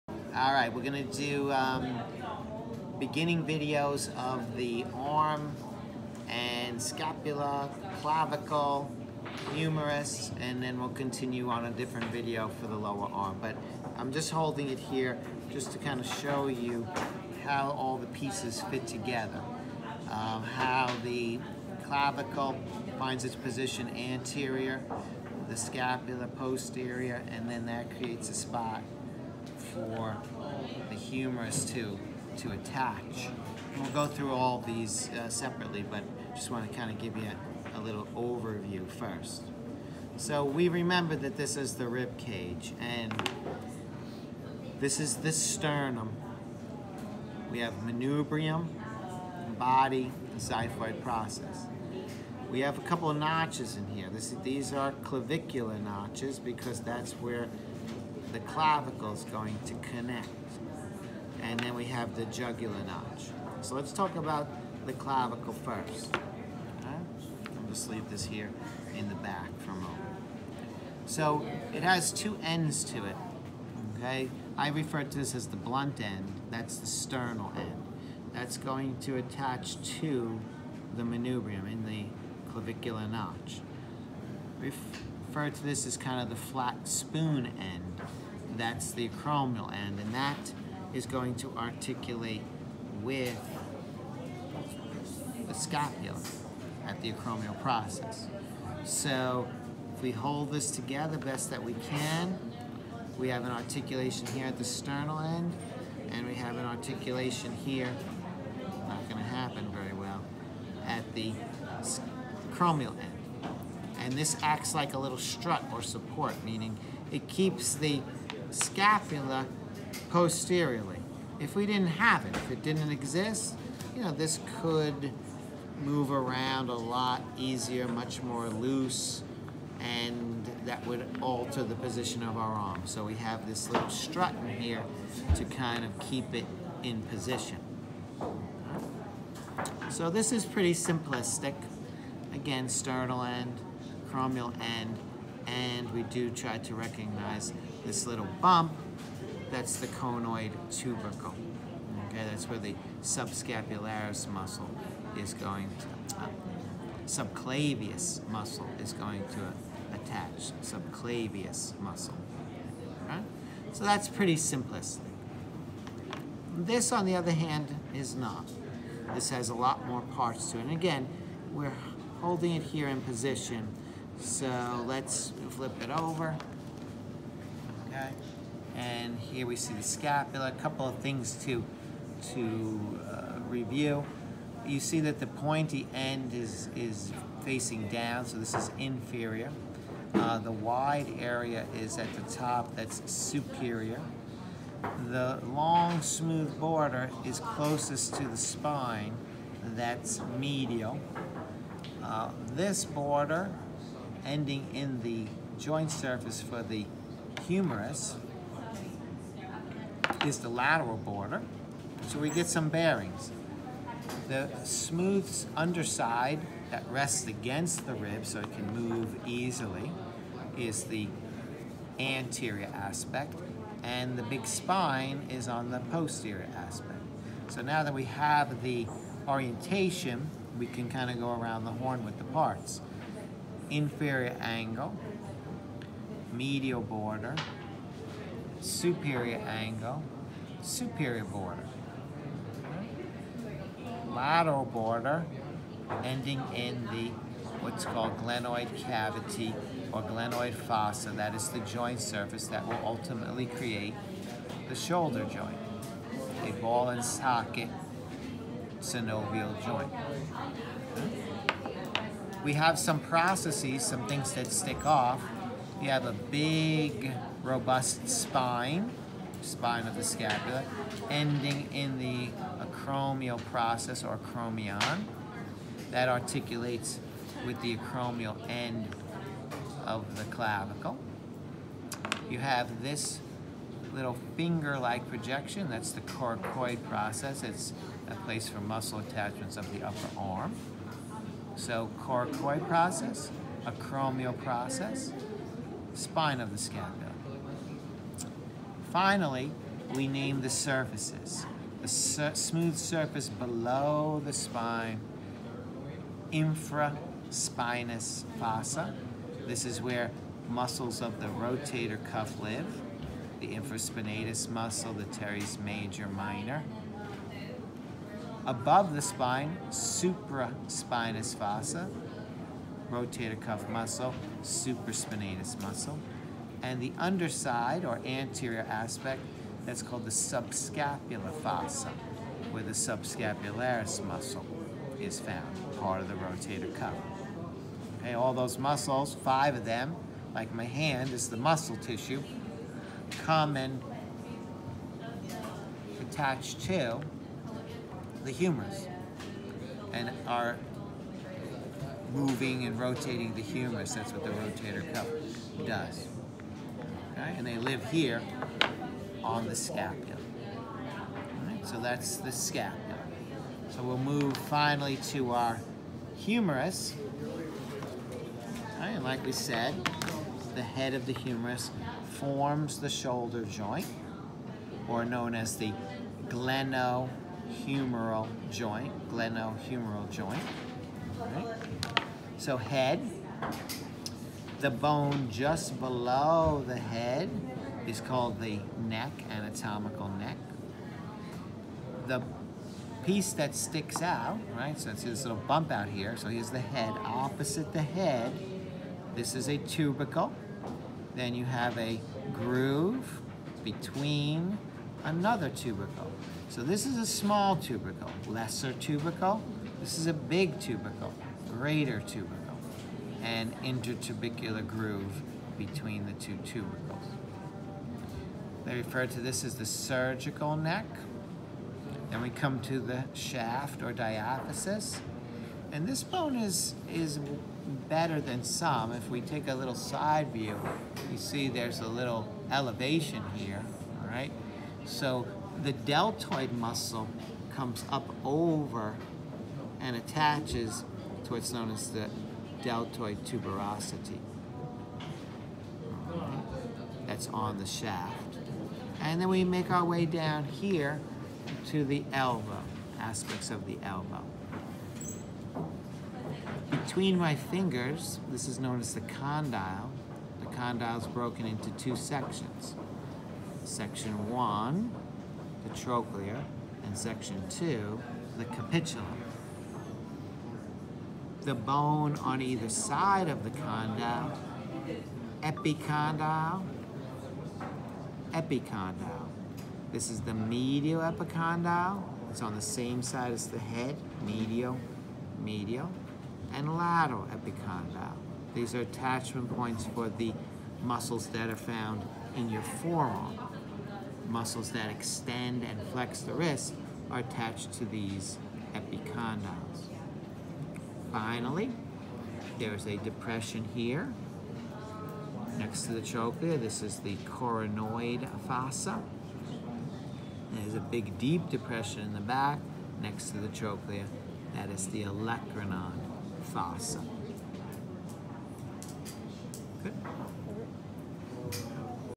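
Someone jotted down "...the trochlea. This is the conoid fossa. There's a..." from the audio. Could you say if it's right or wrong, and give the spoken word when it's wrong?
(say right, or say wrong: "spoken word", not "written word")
wrong: "coronoid", not "conoid".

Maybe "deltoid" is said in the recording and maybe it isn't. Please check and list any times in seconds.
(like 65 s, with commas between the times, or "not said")
435 s, 442 s.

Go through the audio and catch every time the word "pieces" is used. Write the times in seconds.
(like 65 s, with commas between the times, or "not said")
18 s, 393 s.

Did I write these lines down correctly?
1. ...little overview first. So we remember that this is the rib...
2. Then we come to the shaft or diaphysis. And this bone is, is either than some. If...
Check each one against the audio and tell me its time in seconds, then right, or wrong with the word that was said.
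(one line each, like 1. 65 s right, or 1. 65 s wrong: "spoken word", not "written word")
1. 37 s right
2. 422 s wrong: "better", not "either".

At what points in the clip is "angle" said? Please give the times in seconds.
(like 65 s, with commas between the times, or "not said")
234 s, 239 s.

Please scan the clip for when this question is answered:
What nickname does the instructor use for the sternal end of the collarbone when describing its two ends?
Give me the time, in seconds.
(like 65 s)
75 s.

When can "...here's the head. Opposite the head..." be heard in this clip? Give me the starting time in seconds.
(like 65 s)
396 s.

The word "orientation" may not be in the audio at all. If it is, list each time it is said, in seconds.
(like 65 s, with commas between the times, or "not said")
229 s.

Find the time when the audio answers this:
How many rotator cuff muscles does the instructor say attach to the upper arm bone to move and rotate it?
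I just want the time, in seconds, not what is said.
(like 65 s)
339 s.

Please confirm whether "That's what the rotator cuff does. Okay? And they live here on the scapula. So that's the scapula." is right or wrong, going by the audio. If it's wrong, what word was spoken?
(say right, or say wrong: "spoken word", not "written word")
right.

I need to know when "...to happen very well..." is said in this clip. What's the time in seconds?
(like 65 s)
109 s.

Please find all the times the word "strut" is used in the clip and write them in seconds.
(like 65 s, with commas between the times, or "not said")
115 s, 133 s.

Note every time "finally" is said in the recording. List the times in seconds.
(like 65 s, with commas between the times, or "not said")
298 s, 364 s, 501 s.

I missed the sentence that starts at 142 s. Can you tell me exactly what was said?
Again, sternal end, acromial end, and we do try to recognize this little bump, that's the conoid tubercle.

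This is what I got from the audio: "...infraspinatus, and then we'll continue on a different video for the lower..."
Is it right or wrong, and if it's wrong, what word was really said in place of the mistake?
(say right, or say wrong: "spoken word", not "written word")
wrong: "humerus", not "infraspinatus".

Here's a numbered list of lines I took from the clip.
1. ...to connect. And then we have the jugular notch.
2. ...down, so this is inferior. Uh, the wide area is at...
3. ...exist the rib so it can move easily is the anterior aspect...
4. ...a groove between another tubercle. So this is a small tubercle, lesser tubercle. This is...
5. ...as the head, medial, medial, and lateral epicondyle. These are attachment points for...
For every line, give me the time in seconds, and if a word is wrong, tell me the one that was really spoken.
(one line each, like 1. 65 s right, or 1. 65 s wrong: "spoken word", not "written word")
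1. 59 s right
2. 187 s right
3. 217 s wrong: "against", not "exist"
4. 401 s right
5. 483 s right.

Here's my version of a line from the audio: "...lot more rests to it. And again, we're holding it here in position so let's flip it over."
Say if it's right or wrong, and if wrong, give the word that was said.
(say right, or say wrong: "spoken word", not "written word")
wrong: "parts", not "rests".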